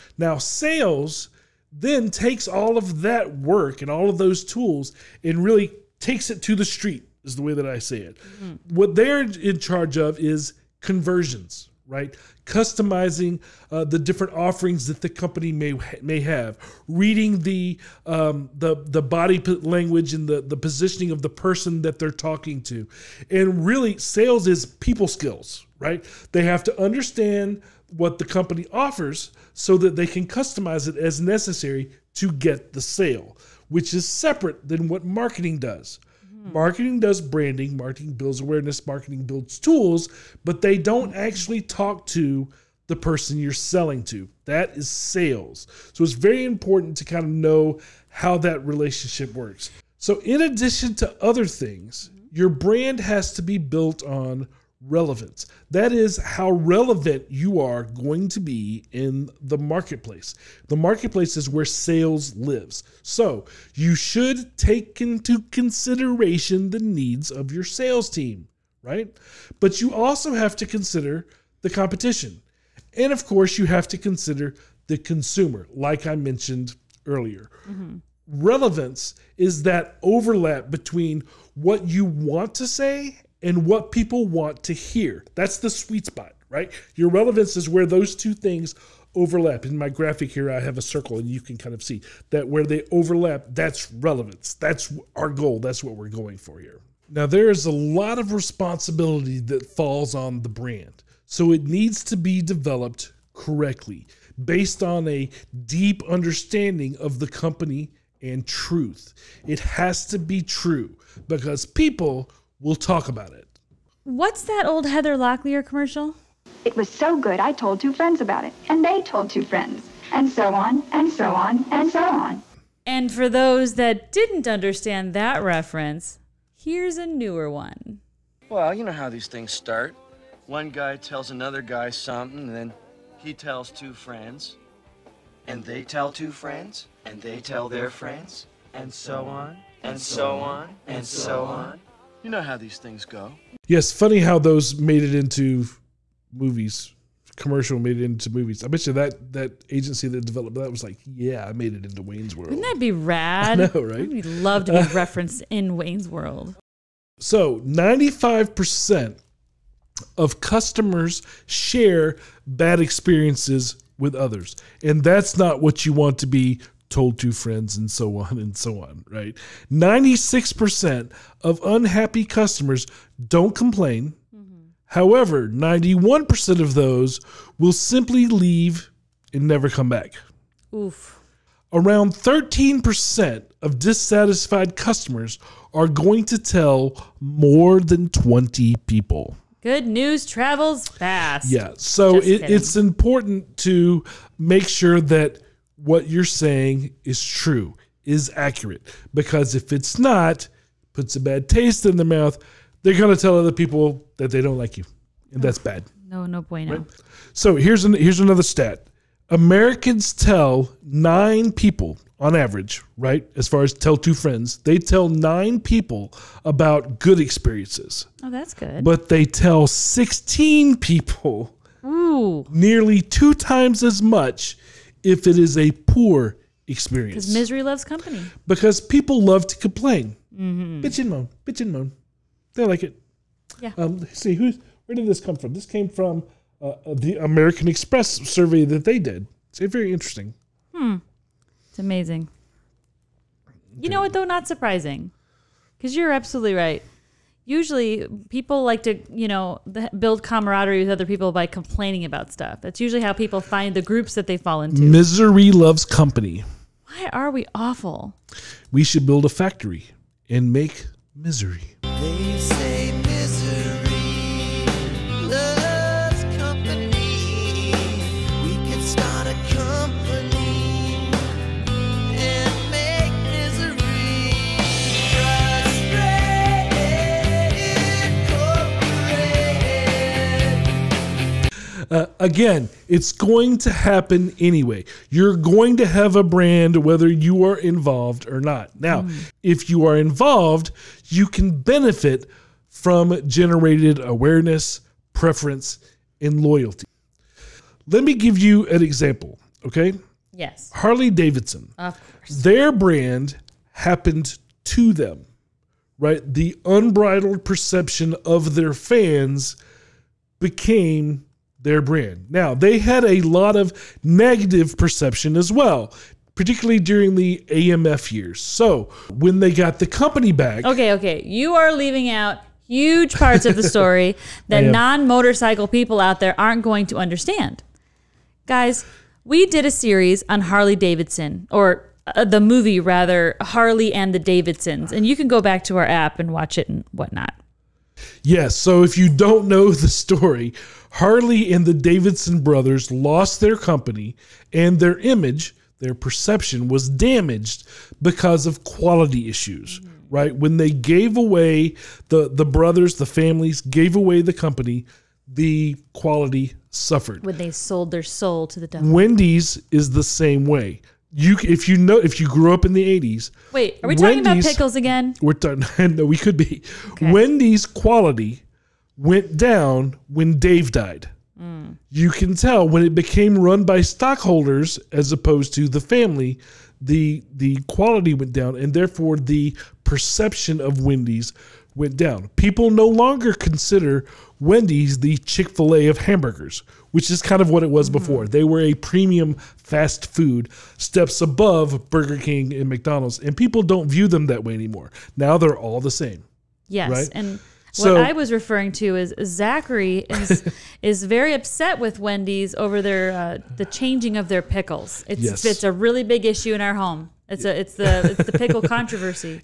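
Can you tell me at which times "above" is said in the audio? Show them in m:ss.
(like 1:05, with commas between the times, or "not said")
6:31.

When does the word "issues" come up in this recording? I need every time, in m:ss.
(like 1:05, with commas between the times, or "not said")
5:49, 6:46.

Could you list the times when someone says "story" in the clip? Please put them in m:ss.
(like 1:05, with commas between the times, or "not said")
5:23, 5:39.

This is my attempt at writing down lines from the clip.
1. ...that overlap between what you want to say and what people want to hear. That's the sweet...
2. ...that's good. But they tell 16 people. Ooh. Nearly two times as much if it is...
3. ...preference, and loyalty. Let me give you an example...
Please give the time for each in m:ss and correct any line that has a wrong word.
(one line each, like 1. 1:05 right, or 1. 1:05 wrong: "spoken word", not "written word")
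1. 1:19 right
2. 3:38 right
3. 4:55 right.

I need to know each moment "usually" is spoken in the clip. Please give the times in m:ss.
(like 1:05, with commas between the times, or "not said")
4:07, 4:12.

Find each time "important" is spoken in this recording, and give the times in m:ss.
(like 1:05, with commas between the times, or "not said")
0:46, 3:12.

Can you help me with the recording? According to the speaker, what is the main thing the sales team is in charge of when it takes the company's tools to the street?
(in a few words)
Conversions.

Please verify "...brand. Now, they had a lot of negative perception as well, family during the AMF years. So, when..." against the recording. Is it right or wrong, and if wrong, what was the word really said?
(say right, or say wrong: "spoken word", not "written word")
wrong: "particularly", not "family".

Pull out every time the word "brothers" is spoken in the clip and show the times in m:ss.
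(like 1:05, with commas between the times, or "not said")
5:42, 5:52.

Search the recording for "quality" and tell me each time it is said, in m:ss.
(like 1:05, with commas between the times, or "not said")
5:48, 5:55, 6:07, 6:17.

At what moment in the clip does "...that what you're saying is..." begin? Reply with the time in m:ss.
3:15.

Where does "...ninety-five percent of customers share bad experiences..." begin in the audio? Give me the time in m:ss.
2:37.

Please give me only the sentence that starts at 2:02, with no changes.
And for those that didn't understand that reference, here's a newer one.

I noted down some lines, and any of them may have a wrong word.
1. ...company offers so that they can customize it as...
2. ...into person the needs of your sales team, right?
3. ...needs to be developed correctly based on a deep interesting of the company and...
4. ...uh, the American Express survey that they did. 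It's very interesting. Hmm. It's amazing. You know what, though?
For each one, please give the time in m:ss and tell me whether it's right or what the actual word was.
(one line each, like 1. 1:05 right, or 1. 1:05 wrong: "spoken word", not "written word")
1. 0:28 right
2. 1:05 wrong: "consideration", not "person"
3. 1:41 wrong: "understanding", not "interesting"
4. 3:56 right.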